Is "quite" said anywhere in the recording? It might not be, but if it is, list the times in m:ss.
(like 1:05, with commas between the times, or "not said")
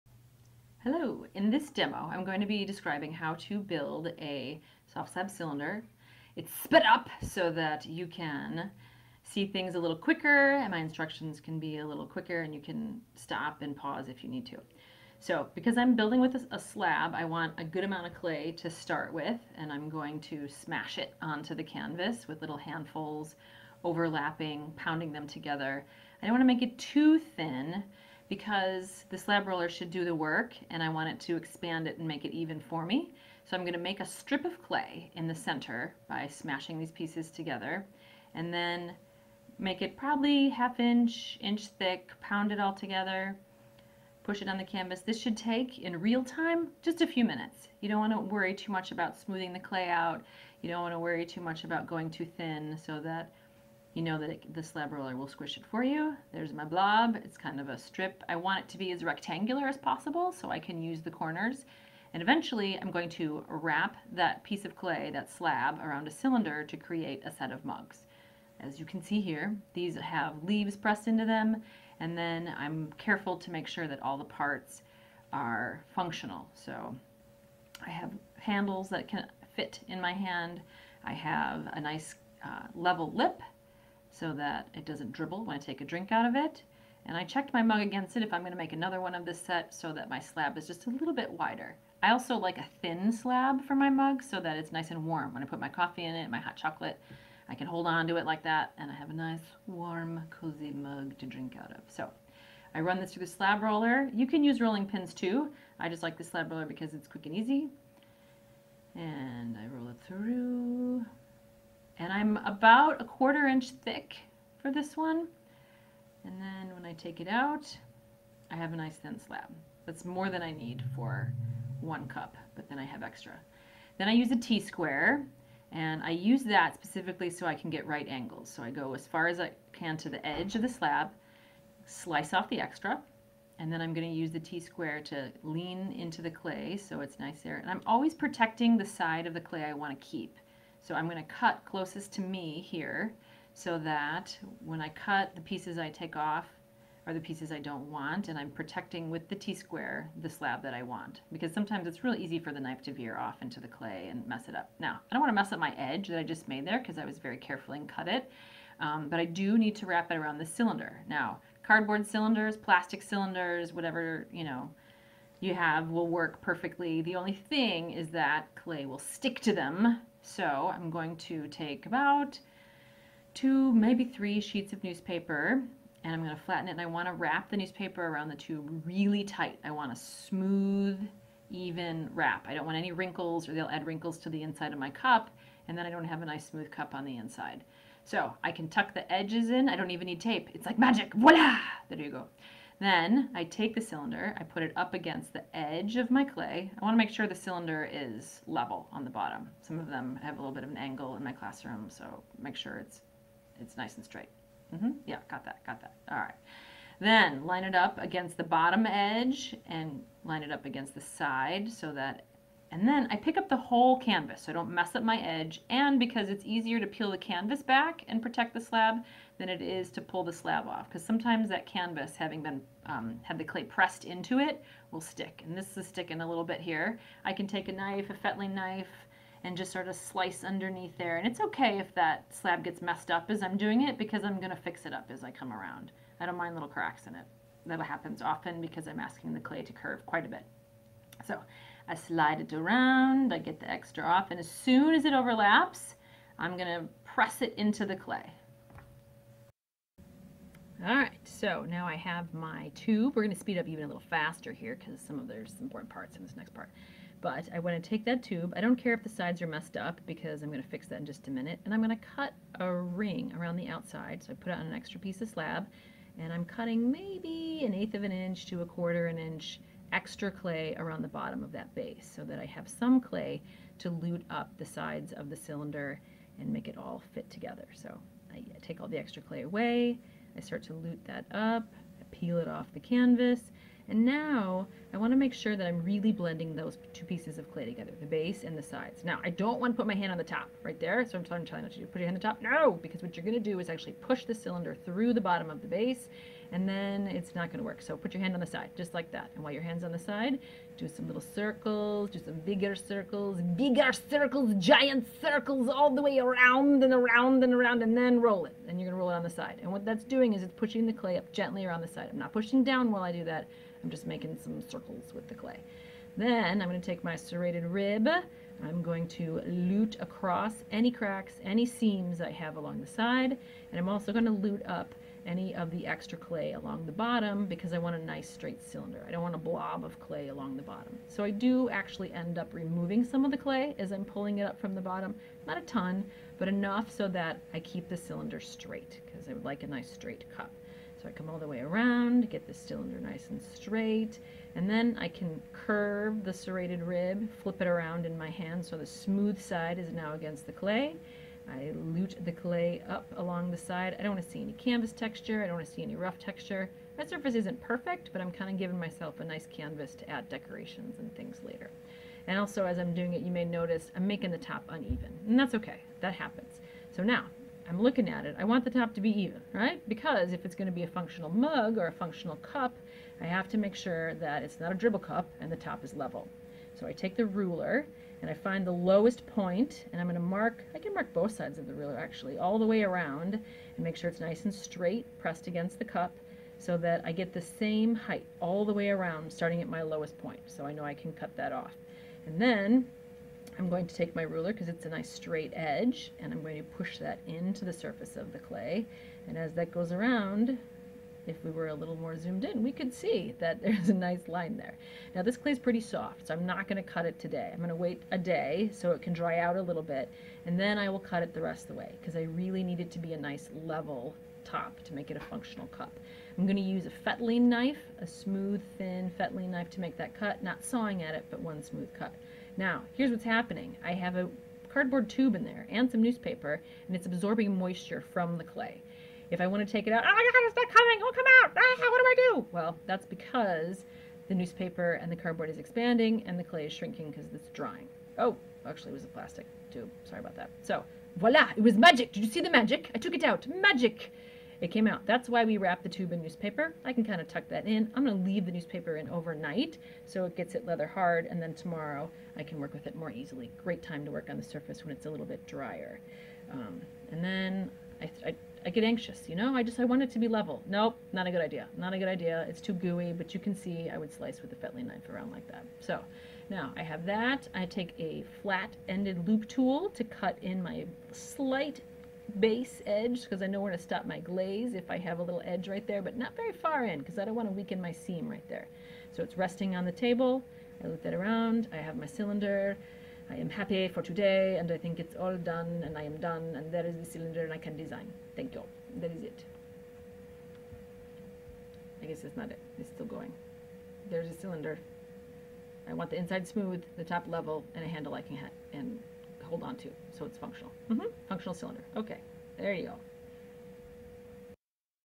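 4:00.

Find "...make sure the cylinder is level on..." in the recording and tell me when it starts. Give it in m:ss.
3:16.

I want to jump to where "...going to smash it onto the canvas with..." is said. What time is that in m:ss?
0:19.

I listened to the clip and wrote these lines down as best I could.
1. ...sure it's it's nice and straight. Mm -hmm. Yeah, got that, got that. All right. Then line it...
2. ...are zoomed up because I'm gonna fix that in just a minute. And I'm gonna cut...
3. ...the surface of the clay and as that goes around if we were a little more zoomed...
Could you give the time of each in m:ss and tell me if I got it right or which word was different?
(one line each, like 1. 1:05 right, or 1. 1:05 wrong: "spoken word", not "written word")
1. 3:22 right
2. 4:19 wrong: "messed", not "zoomed"
3. 6:37 right.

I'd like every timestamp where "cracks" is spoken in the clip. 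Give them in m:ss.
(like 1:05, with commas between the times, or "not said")
3:56, 5:20.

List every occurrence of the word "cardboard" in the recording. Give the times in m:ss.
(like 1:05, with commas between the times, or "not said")
2:41, 7:04, 7:15.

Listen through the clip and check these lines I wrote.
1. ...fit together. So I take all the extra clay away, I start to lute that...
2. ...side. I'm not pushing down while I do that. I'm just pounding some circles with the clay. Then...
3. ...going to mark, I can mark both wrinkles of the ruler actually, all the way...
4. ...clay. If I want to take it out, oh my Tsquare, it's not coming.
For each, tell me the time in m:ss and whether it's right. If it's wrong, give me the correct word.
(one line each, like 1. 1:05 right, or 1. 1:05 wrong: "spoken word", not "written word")
1. 4:37 right
2. 5:11 wrong: "making", not "pounding"
3. 6:20 wrong: "sides", not "wrinkles"
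4. 7:08 wrong: "God", not "Tsquare".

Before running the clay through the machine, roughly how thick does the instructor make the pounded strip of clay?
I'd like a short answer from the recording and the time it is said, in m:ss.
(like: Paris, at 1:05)
half inch, inch, at 0:40.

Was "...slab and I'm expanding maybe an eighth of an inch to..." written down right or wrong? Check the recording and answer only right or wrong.
wrong.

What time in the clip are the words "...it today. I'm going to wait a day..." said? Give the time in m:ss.
6:47.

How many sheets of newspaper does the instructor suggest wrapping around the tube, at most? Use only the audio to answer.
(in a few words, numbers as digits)
3.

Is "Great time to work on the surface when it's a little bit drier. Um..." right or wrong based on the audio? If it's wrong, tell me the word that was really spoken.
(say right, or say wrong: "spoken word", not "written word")
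right.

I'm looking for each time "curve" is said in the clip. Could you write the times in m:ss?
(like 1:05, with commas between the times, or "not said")
3:59, 5:45.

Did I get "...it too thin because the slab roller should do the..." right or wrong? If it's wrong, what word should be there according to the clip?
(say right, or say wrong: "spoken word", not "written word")
right.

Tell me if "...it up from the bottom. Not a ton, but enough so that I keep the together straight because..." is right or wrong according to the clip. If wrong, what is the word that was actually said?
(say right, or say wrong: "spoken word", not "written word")
wrong: "cylinder", not "together".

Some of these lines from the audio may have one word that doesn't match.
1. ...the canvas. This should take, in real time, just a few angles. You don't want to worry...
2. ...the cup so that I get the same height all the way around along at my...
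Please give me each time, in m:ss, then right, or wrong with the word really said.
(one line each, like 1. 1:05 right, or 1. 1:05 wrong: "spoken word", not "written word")
1. 0:44 wrong: "minutes", not "angles"
2. 6:25 wrong: "starting", not "along".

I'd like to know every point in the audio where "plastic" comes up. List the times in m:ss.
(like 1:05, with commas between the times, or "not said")
2:42, 7:19.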